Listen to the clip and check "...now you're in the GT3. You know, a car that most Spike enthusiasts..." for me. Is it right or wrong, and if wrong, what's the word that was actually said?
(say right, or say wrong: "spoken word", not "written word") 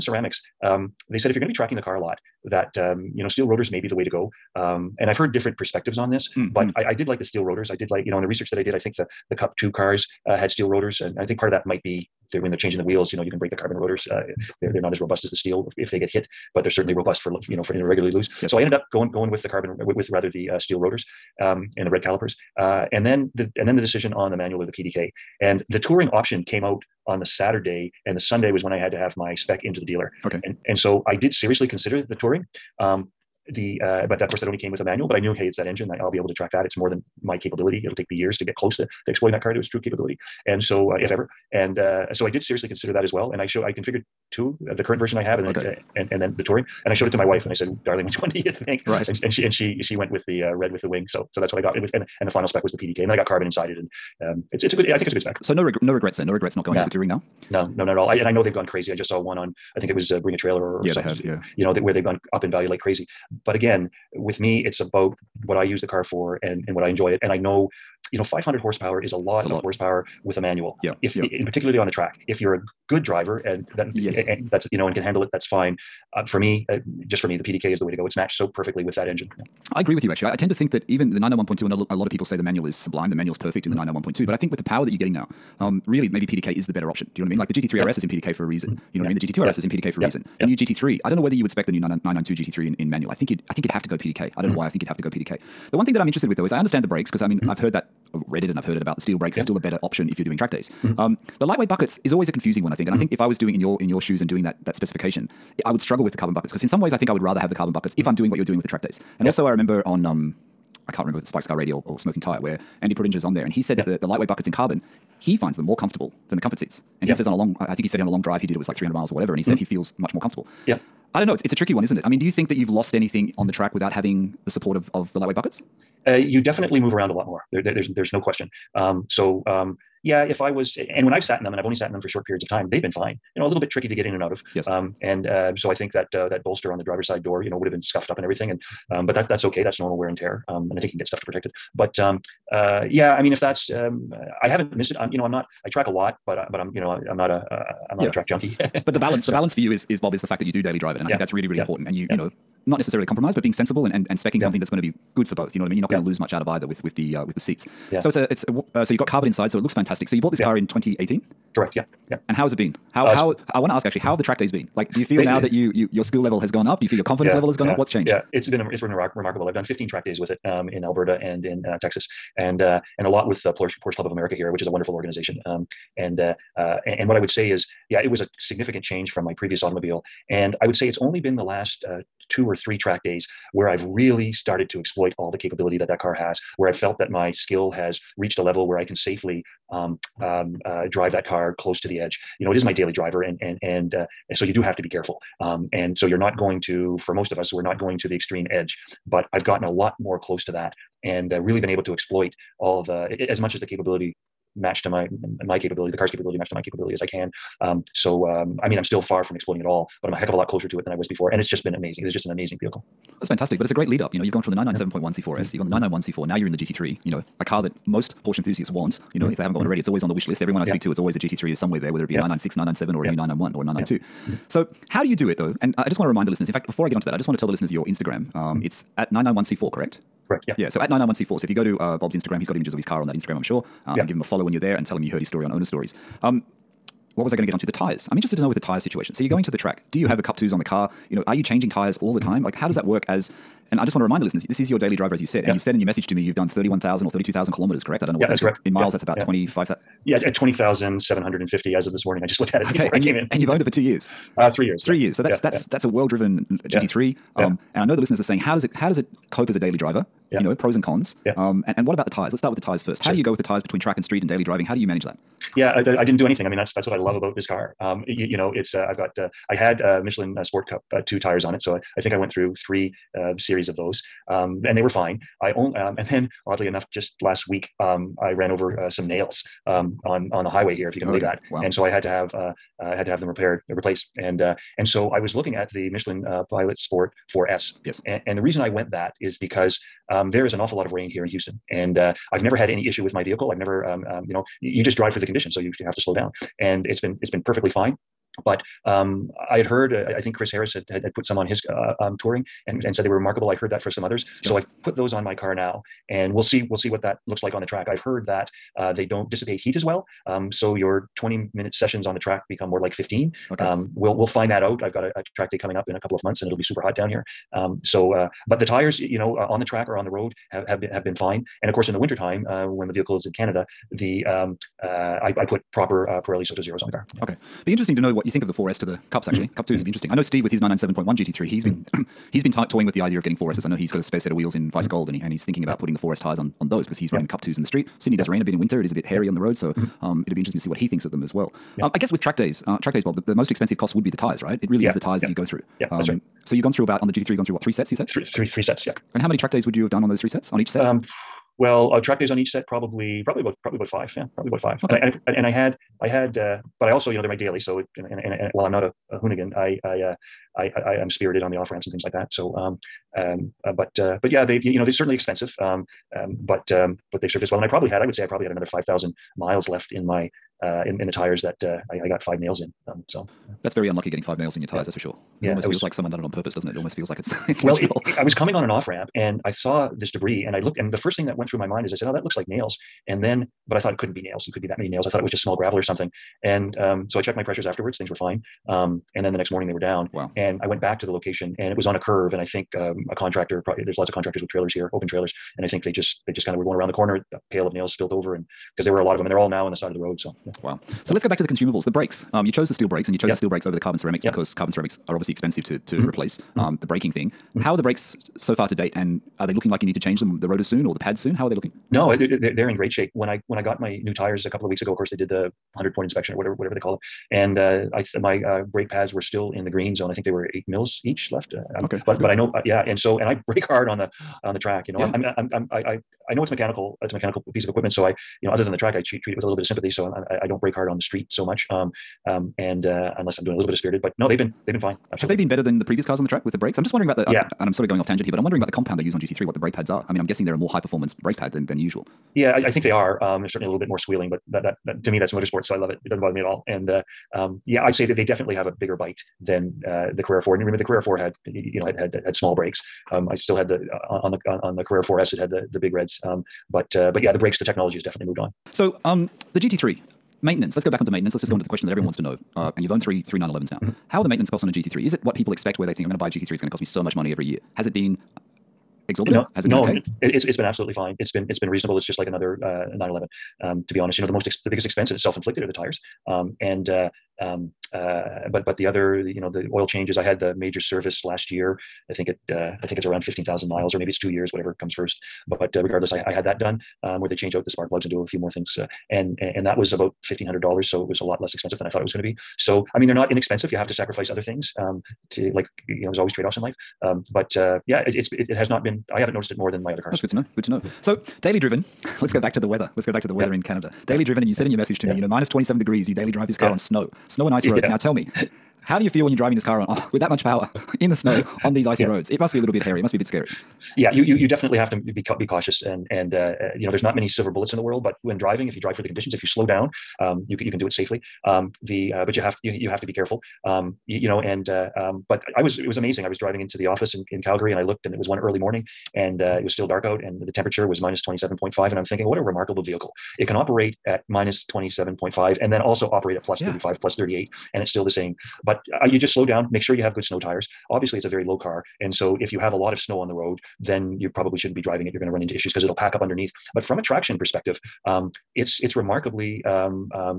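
wrong: "Porsche", not "Spike".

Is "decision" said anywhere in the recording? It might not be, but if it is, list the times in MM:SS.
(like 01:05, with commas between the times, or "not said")
00:23.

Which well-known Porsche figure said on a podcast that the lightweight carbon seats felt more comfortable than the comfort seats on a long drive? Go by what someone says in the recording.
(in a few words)
Andy Preuninger.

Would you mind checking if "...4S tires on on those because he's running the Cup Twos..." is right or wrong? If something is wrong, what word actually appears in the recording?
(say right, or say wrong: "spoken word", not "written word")
right.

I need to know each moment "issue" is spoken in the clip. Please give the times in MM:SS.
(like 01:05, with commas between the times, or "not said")
04:52, 09:05.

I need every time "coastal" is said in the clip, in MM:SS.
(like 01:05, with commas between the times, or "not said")
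not said.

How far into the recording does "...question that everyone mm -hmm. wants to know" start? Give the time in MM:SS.
07:41.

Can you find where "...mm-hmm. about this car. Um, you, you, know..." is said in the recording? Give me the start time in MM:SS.
04:27.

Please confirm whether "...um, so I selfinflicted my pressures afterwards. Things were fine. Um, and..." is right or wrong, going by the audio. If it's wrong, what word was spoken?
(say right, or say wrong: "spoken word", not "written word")
wrong: "checked", not "selfinflicted".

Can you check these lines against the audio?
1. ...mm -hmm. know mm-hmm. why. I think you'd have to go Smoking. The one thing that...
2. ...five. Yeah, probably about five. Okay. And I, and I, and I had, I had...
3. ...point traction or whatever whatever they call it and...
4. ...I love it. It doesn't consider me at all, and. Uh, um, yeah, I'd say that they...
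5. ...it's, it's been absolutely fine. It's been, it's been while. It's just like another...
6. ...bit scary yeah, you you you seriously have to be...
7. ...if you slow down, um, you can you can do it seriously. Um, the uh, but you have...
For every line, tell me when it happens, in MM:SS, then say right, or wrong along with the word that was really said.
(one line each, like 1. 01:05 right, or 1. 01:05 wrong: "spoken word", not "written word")
1. 01:34 wrong: "PDK", not "Smoking"
2. 05:53 right
3. 06:55 wrong: "inspection", not "traction"
4. 07:25 wrong: "bother", not "consider"
5. 07:50 wrong: "reasonable", not "while"
6. 08:33 wrong: "definitely", not "seriously"
7. 08:39 wrong: "safely", not "seriously".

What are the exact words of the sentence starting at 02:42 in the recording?
How uh, how I want to ask actually, how have the track days been?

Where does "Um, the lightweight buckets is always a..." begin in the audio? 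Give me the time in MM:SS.
01:40.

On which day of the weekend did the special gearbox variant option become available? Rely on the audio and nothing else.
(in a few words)
Saturday.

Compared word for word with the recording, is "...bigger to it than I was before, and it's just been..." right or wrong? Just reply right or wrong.
wrong.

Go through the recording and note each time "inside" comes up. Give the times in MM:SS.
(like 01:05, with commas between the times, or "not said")
00:53, 02:39.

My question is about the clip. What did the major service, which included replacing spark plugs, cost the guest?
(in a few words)
$1500.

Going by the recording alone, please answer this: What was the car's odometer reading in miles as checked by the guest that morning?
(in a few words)
20,750.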